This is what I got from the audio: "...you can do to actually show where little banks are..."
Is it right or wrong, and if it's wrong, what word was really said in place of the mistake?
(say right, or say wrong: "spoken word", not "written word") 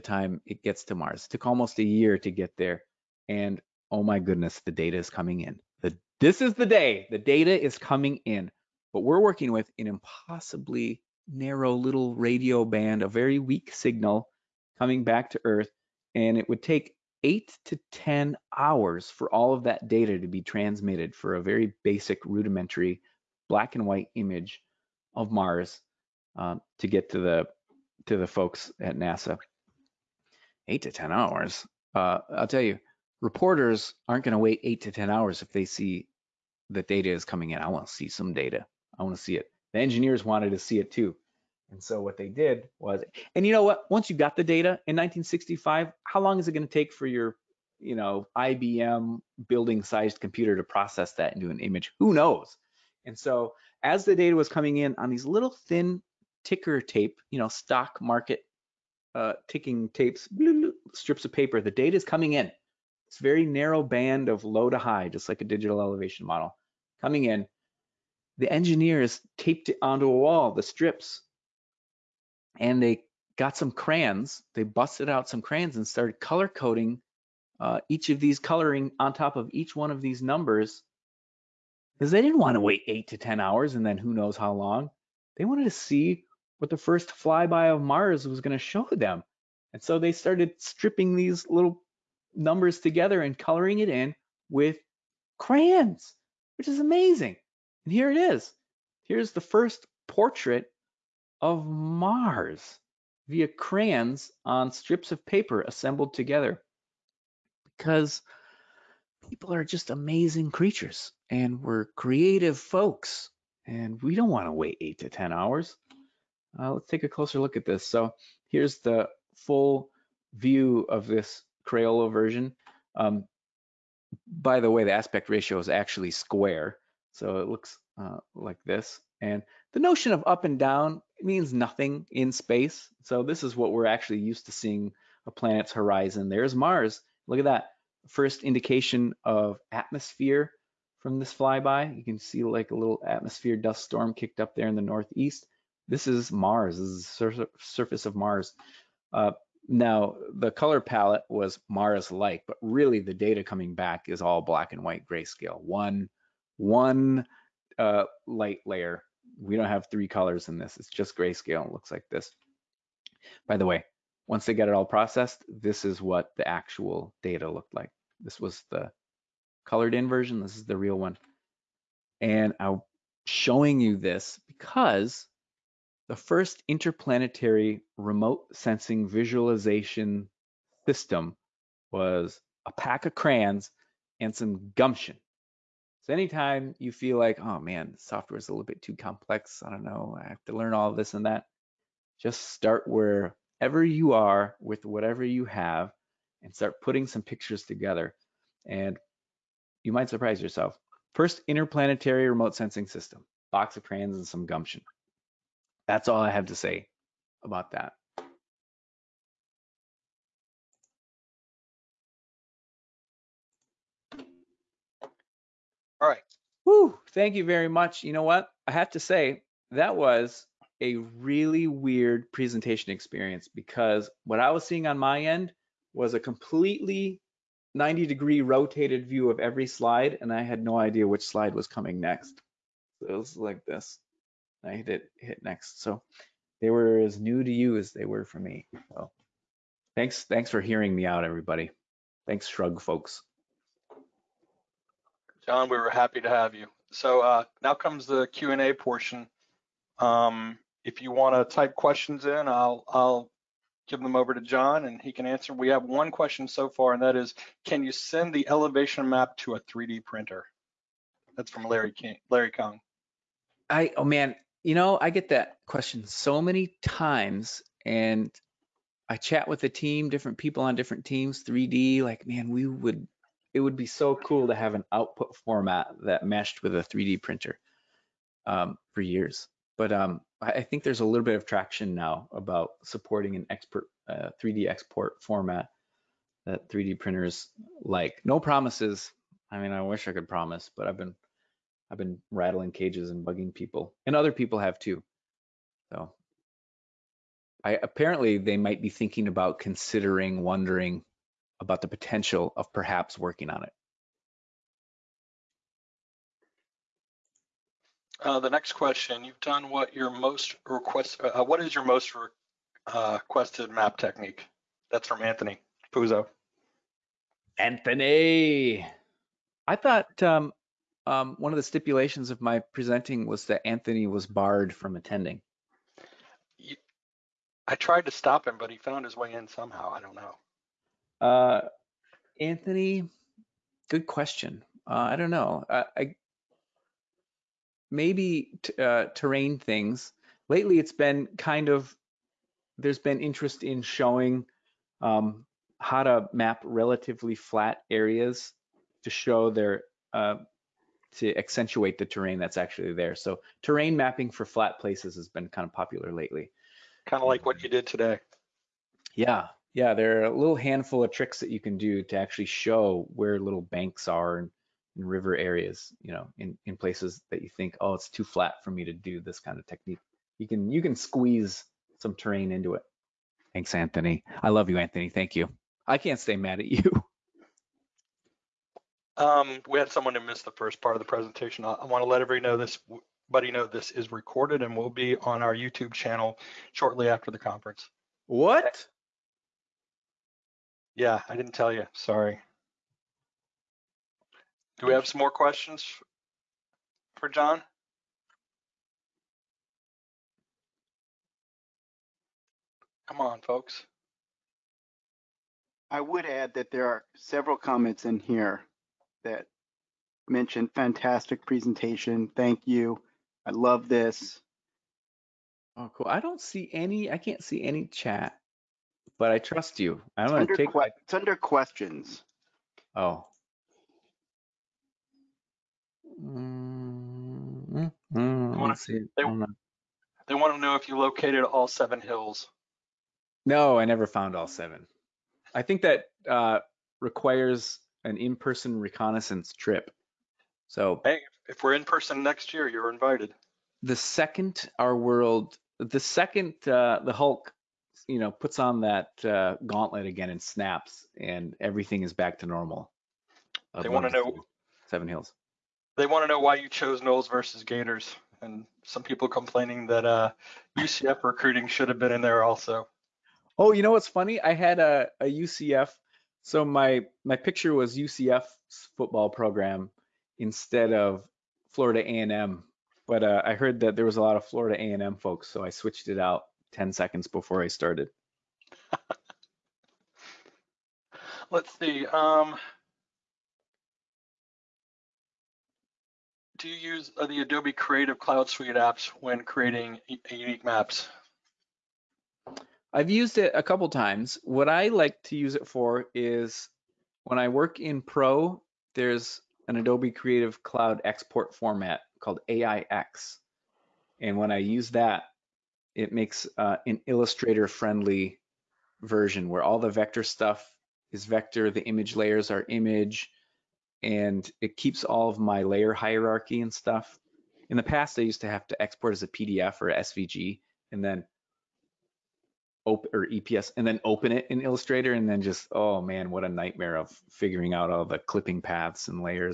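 right.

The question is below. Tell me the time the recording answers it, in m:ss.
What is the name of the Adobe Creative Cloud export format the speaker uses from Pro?
8:22.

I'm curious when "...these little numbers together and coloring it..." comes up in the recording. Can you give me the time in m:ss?
1:31.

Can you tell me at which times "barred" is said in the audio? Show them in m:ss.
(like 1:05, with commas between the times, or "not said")
5:24.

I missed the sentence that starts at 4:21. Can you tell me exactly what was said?
That's from Larry King, Larry Kong.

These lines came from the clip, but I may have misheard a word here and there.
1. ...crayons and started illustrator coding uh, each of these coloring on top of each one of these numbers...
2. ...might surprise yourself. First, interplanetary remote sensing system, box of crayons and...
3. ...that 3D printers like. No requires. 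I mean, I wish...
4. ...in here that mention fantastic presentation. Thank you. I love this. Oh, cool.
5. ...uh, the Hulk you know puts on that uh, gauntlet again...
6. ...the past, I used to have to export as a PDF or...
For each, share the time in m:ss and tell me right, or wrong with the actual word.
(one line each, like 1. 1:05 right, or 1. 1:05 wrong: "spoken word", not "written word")
1. 1:15 wrong: "color", not "illustrator"
2. 3:19 right
3. 4:46 wrong: "promises", not "requires"
4. 6:48 right
5. 7:26 right
6. 8:37 right.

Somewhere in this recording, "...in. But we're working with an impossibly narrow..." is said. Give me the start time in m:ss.
0:08.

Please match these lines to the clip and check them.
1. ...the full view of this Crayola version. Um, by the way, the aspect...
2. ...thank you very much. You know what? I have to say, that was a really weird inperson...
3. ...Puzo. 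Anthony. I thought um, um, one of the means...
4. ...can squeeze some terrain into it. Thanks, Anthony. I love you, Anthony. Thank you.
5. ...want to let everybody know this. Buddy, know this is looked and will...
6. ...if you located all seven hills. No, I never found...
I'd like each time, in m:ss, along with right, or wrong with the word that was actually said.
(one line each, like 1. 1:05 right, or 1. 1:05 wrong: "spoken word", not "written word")
1. 1:58 right
2. 3:37 wrong: "presentation", not "inperson"
3. 5:15 wrong: "stipulations", not "means"
4. 6:10 right
5. 6:21 wrong: "recorded", not "looked"
6. 7:10 right.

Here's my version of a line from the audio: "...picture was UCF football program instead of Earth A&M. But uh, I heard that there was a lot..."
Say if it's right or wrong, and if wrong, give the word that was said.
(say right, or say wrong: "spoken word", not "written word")
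wrong: "Florida", not "Earth".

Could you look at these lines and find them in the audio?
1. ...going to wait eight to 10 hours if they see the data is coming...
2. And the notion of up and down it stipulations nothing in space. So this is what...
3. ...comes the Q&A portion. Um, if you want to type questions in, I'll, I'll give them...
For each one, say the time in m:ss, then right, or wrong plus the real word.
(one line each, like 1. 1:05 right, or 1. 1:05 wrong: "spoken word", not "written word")
1. 0:34 right
2. 2:09 wrong: "means", not "stipulations"
3. 4:07 right.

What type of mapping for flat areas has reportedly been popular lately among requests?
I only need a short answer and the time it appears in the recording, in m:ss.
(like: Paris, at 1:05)
terrain mapping, at 5:53.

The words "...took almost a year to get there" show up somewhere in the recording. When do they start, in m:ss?
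0:01.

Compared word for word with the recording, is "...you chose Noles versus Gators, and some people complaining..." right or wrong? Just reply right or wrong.
right.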